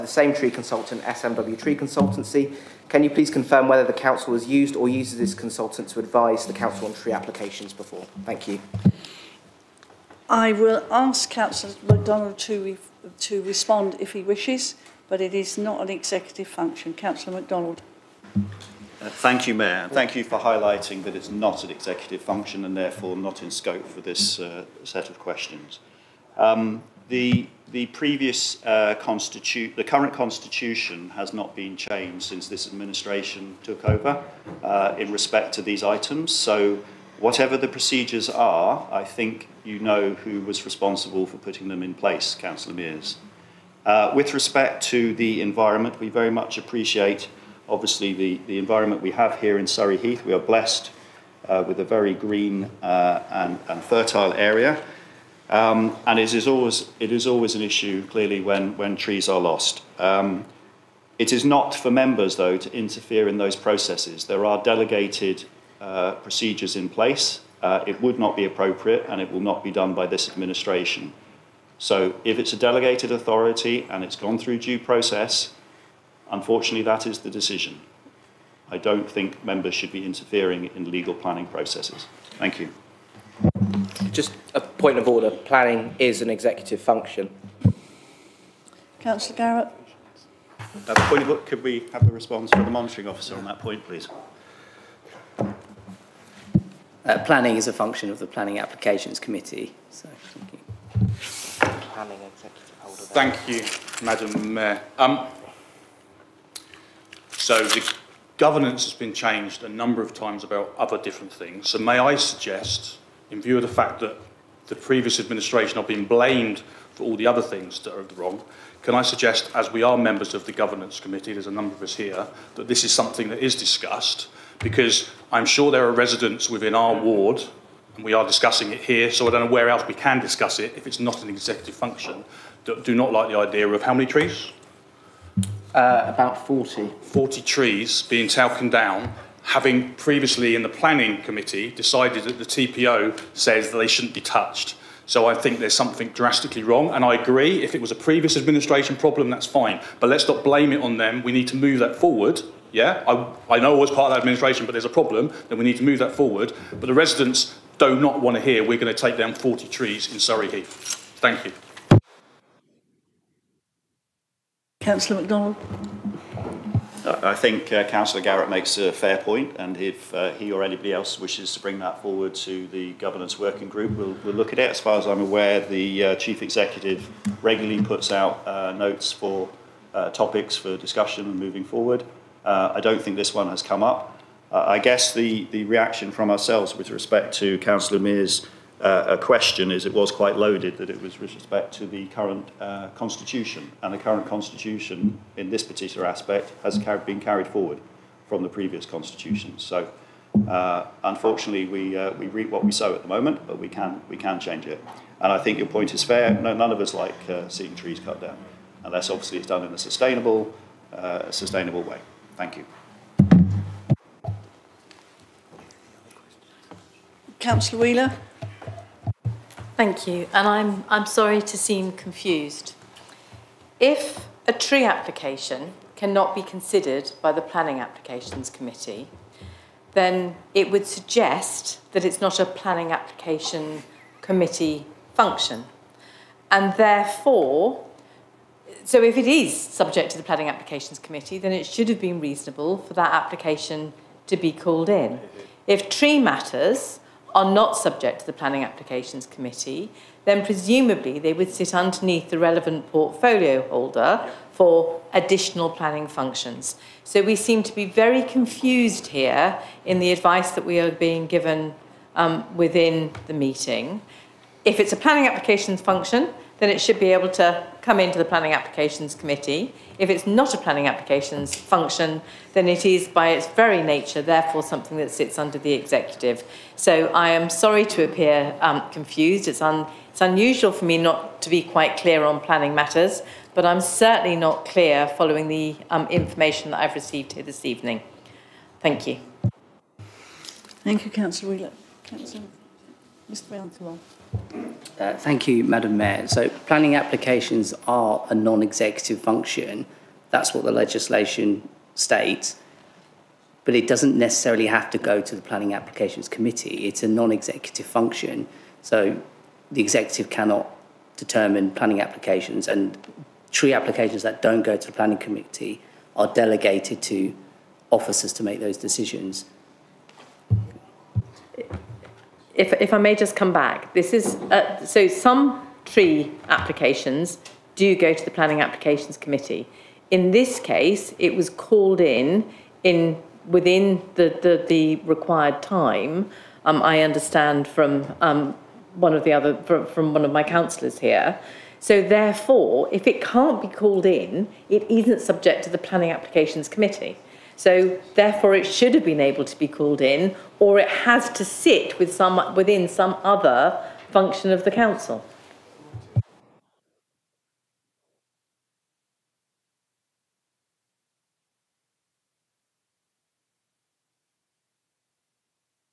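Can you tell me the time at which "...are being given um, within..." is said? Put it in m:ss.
4:20.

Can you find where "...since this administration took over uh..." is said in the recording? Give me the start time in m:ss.
0:32.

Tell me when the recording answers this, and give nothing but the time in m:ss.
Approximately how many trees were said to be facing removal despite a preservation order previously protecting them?
2:16.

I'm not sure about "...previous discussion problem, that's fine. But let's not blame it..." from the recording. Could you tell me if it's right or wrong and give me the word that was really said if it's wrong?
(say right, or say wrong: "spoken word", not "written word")
wrong: "administration", not "discussion".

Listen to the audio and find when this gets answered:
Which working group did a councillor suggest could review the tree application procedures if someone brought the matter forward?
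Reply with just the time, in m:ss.
2:52.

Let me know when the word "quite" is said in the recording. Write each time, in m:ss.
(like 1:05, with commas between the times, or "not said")
3:10, 4:41.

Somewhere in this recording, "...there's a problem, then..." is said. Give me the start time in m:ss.
2:34.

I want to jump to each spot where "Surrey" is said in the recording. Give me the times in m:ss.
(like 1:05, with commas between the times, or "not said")
0:49, 2:40.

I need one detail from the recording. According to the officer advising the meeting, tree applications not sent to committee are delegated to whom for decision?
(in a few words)
officers.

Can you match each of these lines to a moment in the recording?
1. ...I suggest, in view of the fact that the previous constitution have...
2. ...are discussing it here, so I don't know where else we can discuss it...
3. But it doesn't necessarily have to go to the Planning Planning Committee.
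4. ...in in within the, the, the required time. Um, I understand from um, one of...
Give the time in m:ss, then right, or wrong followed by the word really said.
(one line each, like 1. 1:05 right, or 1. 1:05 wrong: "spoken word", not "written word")
1. 1:51 wrong: "administration", not "constitution"
2. 2:08 right
3. 5:03 wrong: "Applications", not "Planning"
4. 5:32 right.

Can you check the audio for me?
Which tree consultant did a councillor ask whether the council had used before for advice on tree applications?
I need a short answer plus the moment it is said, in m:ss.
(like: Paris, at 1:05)
SMW Tree Consultancy, at 0:01.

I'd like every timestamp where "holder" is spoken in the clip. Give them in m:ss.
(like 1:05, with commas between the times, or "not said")
1:42, 4:13.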